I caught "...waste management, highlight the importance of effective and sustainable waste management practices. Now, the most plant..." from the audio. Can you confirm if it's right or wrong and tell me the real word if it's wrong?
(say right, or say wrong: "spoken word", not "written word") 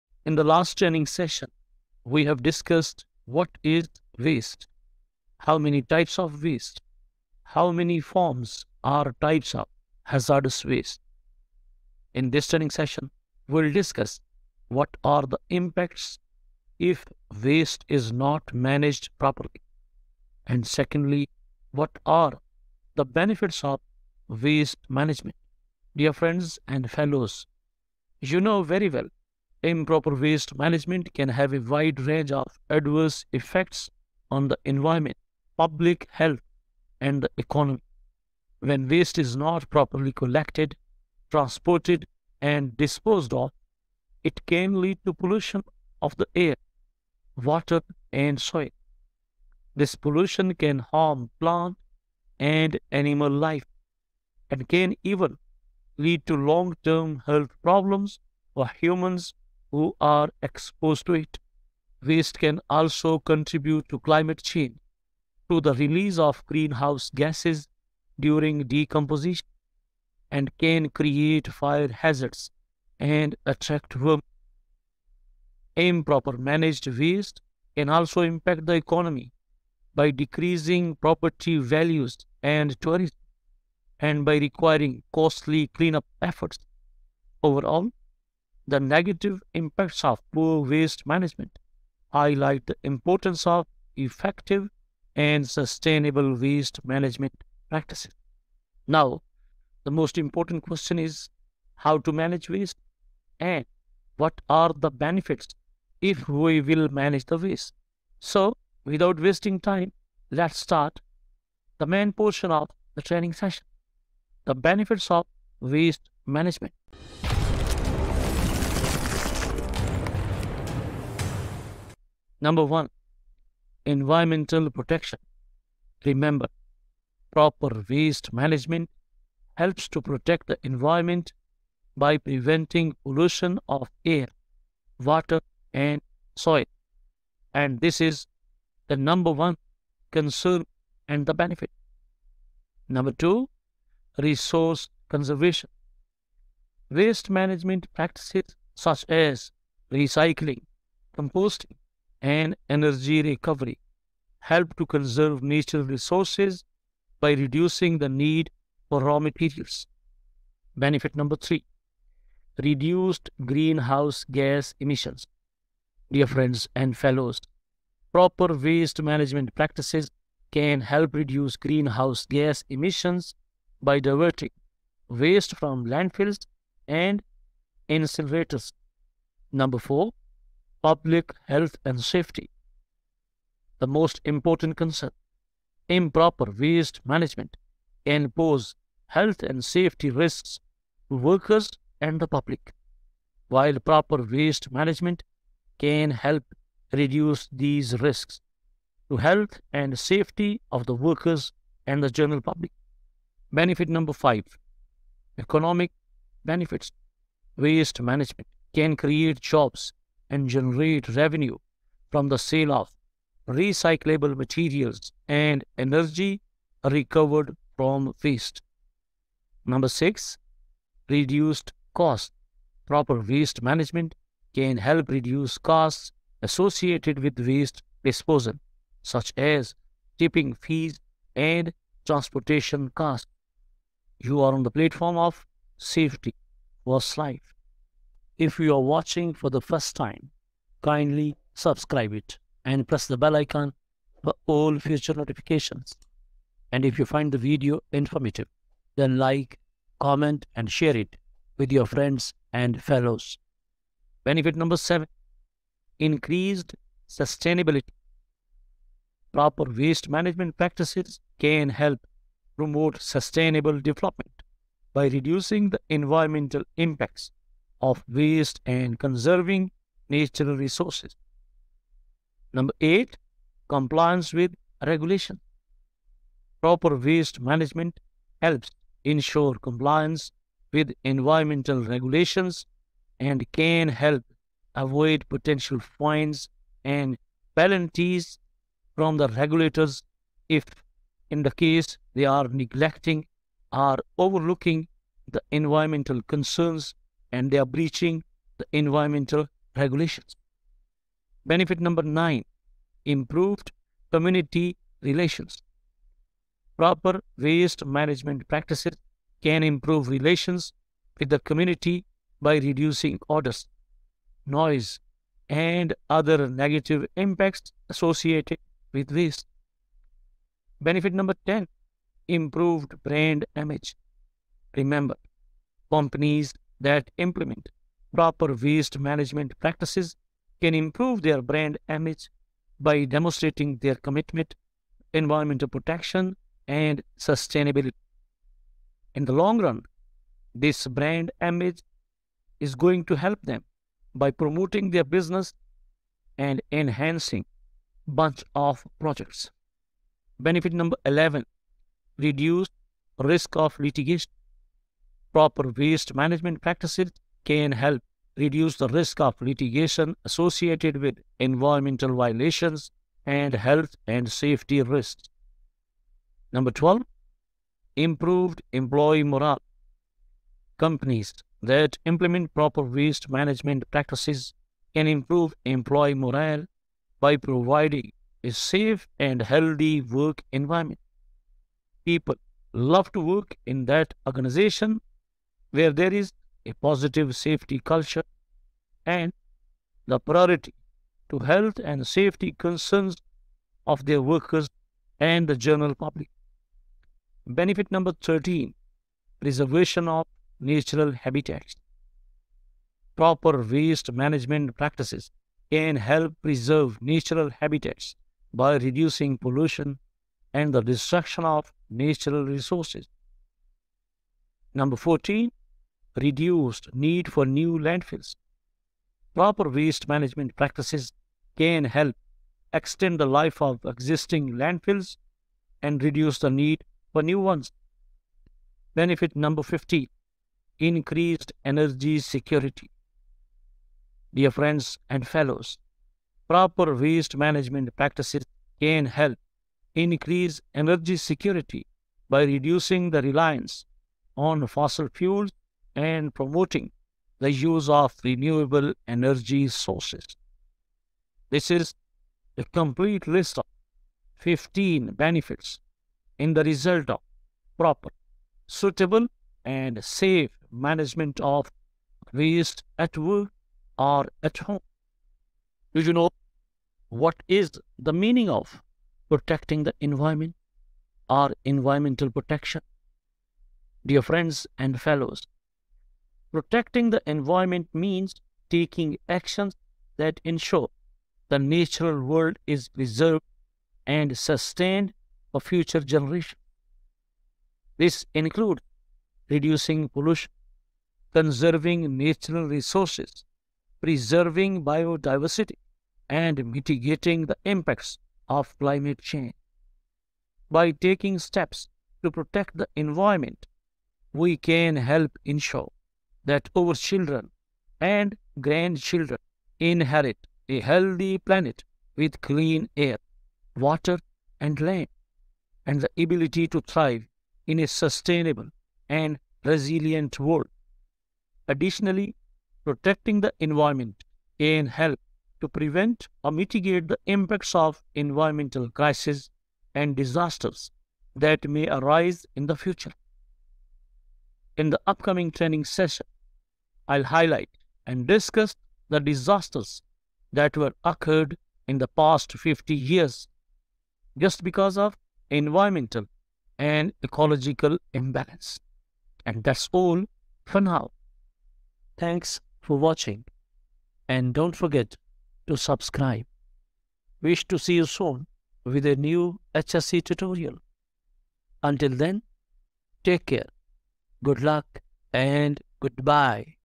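wrong: "important", not "plant".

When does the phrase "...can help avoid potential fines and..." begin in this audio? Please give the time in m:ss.
4:43.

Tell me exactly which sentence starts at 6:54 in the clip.
Number 14 reduced need for new landfills.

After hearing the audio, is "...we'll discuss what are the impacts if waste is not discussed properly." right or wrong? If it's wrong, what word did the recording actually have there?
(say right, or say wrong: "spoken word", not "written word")
wrong: "managed", not "discussed".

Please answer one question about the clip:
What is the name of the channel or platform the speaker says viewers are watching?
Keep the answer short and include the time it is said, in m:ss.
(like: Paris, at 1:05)
Safety First Life, at 3:55.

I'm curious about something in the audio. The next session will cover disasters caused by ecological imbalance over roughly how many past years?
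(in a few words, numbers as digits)
50.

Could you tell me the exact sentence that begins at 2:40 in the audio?
Benefit number three, reduced greenhouse gas emissions.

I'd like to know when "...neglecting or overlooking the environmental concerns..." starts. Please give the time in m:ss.
4:52.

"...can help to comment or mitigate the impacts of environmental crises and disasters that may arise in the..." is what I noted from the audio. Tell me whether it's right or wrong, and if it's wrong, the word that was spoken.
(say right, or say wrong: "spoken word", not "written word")
wrong: "prevent", not "comment".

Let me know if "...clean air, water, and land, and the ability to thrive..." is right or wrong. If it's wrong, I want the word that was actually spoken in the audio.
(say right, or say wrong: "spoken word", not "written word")
right.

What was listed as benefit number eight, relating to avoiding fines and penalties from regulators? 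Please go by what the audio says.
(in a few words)
Compliance with regulation.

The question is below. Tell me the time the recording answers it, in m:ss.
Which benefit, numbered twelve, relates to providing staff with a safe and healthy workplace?
6:07.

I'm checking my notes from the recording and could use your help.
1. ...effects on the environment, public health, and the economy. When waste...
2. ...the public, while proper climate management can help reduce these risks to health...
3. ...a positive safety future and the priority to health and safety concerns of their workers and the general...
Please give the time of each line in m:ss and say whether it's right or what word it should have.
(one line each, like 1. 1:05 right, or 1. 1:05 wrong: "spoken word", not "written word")
1. 0:33 right
2. 3:12 wrong: "waste", not "climate"
3. 6:26 wrong: "culture", not "future".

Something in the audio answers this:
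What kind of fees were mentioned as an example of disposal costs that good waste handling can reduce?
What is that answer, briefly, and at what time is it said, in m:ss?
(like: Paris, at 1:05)
Tipping fees, at 3:50.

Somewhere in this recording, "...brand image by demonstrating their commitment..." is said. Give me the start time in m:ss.
5:31.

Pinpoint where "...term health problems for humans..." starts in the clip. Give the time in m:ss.
0:56.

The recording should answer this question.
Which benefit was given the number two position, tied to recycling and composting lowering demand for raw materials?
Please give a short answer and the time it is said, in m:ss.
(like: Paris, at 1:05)
Resource conservation, at 2:24.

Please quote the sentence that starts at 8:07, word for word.
This includes reducing pollution, conserving natural resources, preserving biodiversity, and mitigating the impacts of climate change.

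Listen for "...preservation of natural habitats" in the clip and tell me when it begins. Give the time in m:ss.
6:39.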